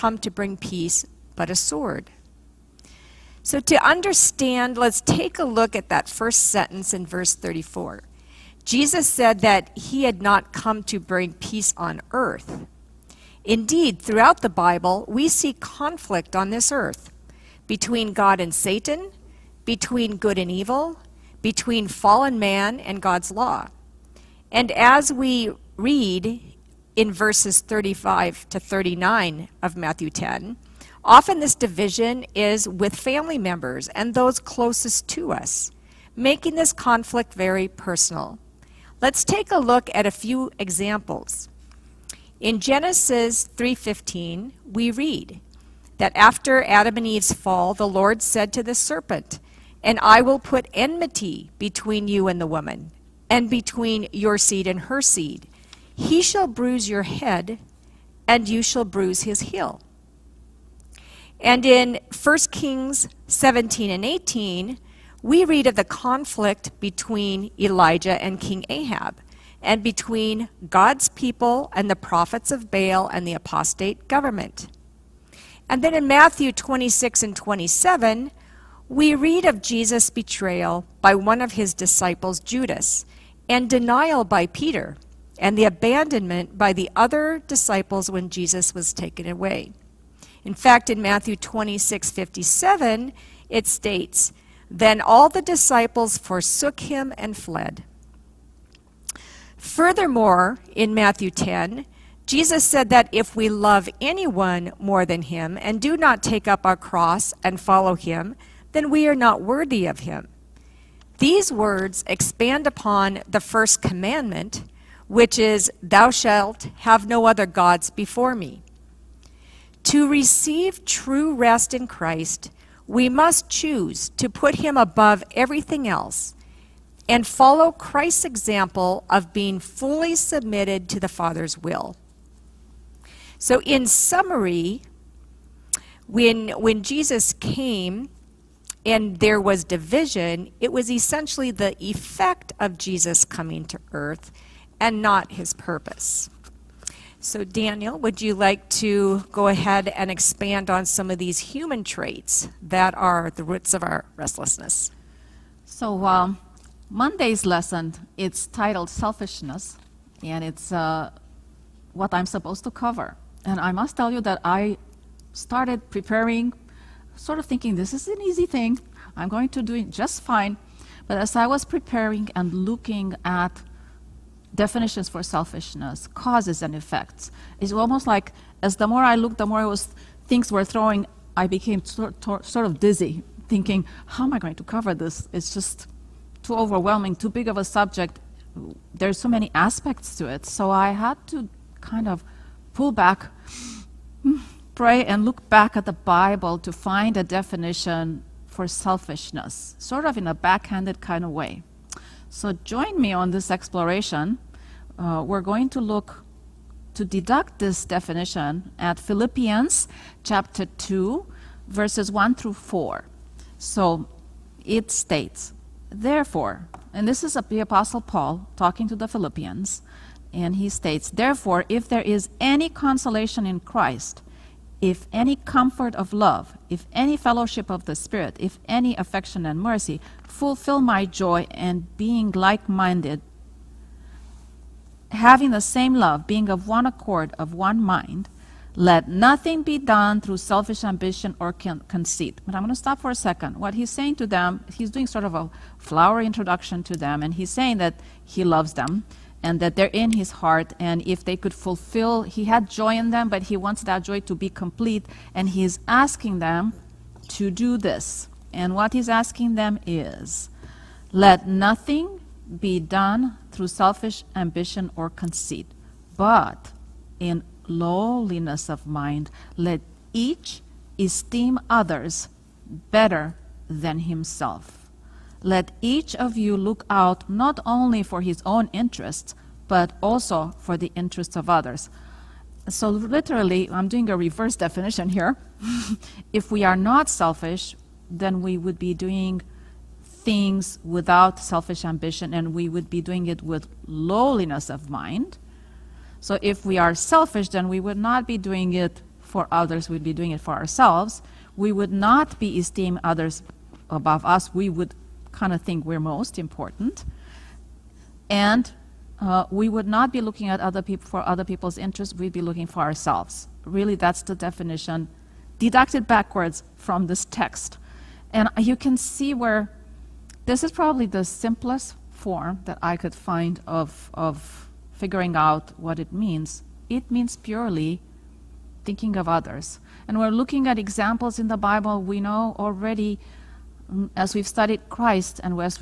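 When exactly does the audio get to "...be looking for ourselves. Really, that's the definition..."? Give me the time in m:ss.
5:12.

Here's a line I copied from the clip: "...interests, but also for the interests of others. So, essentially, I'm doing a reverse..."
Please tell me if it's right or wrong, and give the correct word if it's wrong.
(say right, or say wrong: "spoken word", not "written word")
wrong: "literally", not "essentially".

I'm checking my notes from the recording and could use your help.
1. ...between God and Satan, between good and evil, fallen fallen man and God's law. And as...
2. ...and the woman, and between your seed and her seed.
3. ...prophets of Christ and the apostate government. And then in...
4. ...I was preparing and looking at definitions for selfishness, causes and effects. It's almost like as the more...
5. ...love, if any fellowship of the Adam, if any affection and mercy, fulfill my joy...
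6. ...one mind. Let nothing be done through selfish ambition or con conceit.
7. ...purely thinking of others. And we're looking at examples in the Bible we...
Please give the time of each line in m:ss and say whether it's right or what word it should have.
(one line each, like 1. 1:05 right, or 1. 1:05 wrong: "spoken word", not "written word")
1. 0:17 wrong: "between", not "fallen"
2. 0:52 right
3. 1:11 wrong: "Baal", not "Christ"
4. 2:51 right
5. 3:46 wrong: "Spirit", not "Adam"
6. 3:57 right
7. 5:27 right.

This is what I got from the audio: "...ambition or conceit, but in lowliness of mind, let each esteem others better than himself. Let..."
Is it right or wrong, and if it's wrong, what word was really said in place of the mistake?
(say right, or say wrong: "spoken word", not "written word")
right.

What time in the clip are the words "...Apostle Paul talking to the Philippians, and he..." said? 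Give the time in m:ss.
3:37.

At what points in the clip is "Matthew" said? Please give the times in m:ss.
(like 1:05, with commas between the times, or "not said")
0:29, 1:16, 1:30, 1:40.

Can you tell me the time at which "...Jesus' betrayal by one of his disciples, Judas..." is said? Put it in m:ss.
1:19.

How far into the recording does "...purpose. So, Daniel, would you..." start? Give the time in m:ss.
2:25.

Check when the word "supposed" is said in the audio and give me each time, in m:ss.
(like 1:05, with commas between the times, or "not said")
2:42.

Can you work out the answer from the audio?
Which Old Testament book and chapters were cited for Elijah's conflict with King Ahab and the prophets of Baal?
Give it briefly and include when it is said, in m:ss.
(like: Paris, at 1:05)
1 Kings 17 and 18, at 1:02.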